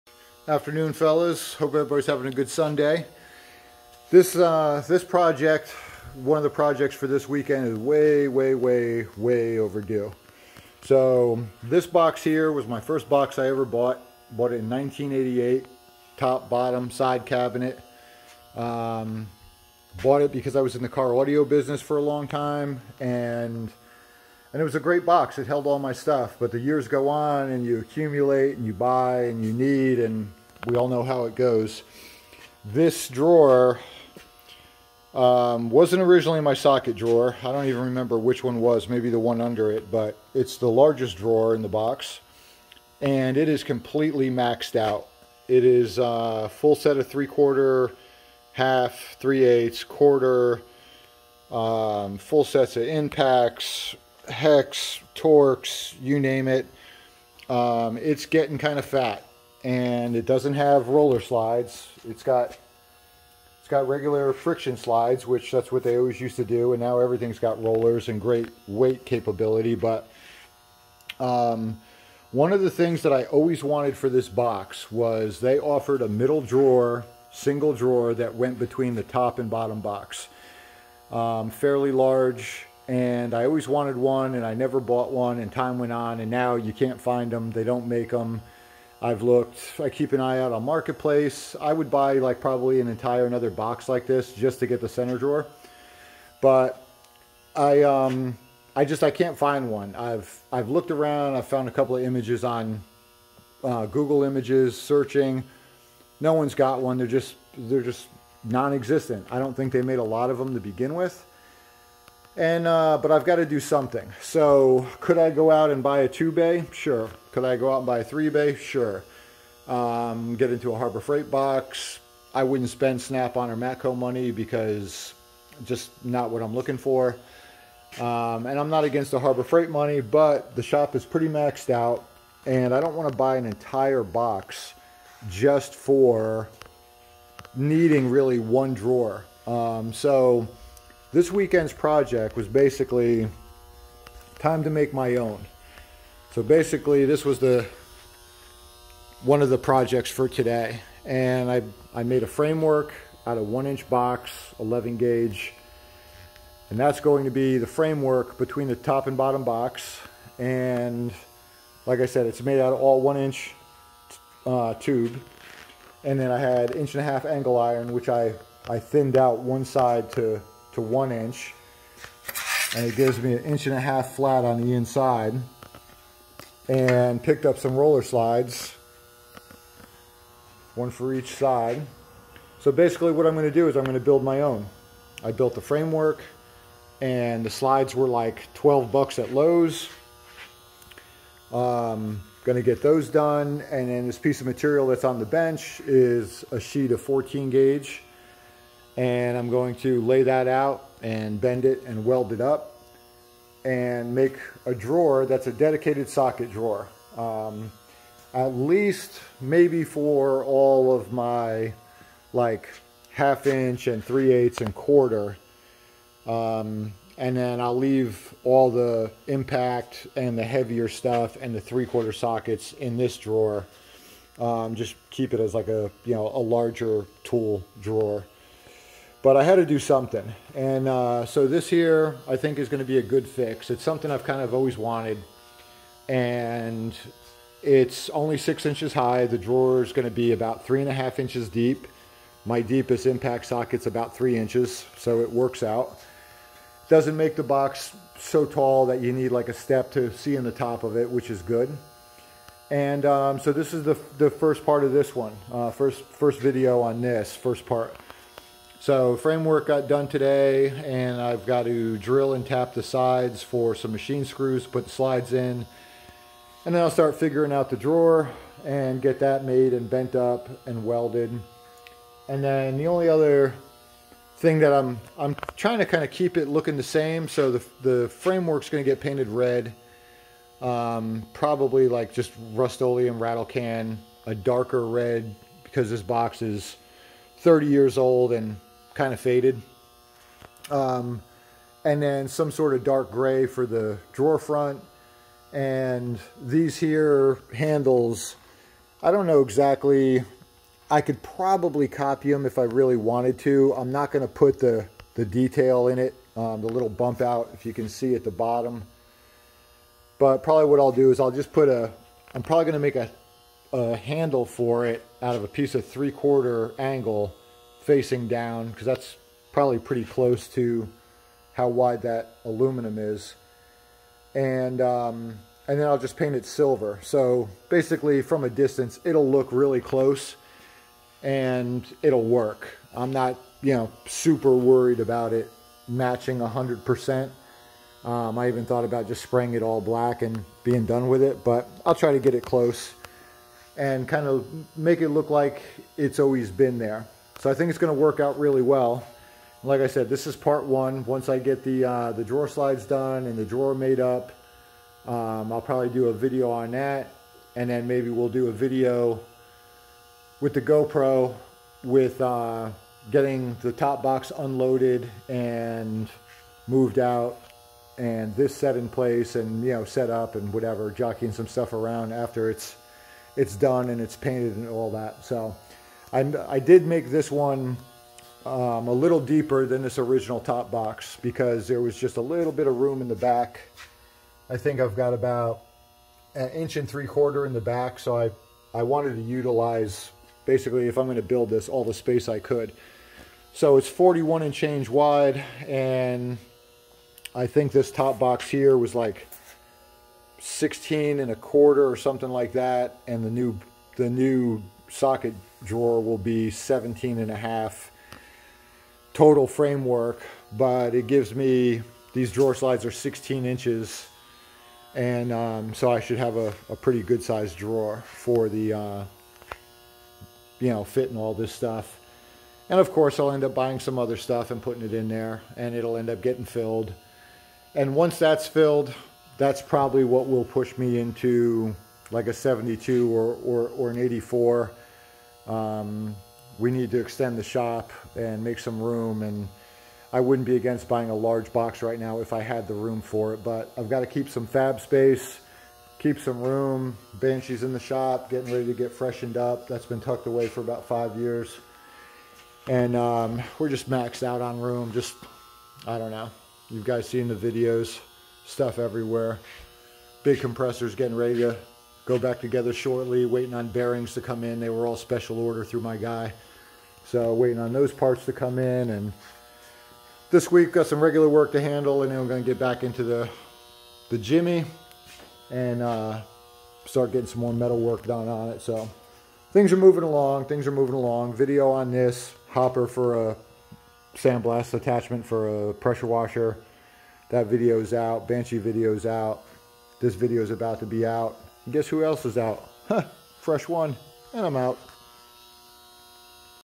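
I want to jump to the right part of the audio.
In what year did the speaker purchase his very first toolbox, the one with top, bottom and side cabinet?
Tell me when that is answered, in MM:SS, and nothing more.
00:14.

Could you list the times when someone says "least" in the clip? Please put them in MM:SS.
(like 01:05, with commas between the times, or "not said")
03:28.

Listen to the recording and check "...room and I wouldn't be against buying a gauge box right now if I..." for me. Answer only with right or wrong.
wrong.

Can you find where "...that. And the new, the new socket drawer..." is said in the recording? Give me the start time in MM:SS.
06:42.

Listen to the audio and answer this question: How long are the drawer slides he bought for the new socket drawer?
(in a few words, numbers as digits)
16 inches.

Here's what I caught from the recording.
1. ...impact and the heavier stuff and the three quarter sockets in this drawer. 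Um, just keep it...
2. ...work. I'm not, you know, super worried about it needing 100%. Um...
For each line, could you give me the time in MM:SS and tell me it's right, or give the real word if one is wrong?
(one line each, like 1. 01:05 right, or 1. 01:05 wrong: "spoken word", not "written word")
1. 03:39 right
2. 05:32 wrong: "matching", not "needing".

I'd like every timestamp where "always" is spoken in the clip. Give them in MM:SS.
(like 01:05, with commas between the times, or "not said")
01:05, 01:13, 01:23, 03:54, 05:46.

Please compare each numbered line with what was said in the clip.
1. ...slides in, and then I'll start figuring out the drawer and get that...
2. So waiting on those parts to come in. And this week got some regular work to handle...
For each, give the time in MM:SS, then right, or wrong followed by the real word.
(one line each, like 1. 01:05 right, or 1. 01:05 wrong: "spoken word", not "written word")
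1. 04:24 right
2. 07:47 right.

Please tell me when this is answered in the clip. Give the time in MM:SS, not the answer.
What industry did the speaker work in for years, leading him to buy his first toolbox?
00:20.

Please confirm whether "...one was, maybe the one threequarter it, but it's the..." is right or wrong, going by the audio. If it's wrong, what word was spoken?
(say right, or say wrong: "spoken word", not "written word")
wrong: "under", not "threequarter".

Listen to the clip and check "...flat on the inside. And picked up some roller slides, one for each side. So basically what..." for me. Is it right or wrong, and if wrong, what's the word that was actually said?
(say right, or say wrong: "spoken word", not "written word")
right.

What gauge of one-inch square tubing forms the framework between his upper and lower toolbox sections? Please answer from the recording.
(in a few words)
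11 gauge.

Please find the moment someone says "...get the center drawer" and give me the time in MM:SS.
01:34.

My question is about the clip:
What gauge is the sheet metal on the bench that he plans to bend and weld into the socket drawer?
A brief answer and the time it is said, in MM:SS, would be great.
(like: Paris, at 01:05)
14 gauge, at 03:17.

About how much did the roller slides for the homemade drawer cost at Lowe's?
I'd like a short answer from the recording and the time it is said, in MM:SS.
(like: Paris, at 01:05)
$12, at 03:08.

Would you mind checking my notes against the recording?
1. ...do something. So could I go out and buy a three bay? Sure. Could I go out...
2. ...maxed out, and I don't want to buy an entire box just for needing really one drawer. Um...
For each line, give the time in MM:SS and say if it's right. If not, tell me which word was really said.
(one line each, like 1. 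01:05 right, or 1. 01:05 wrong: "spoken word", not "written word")
1. 01:53 wrong: "two", not "three"
2. 02:11 right.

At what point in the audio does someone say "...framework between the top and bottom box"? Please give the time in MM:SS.
02:37.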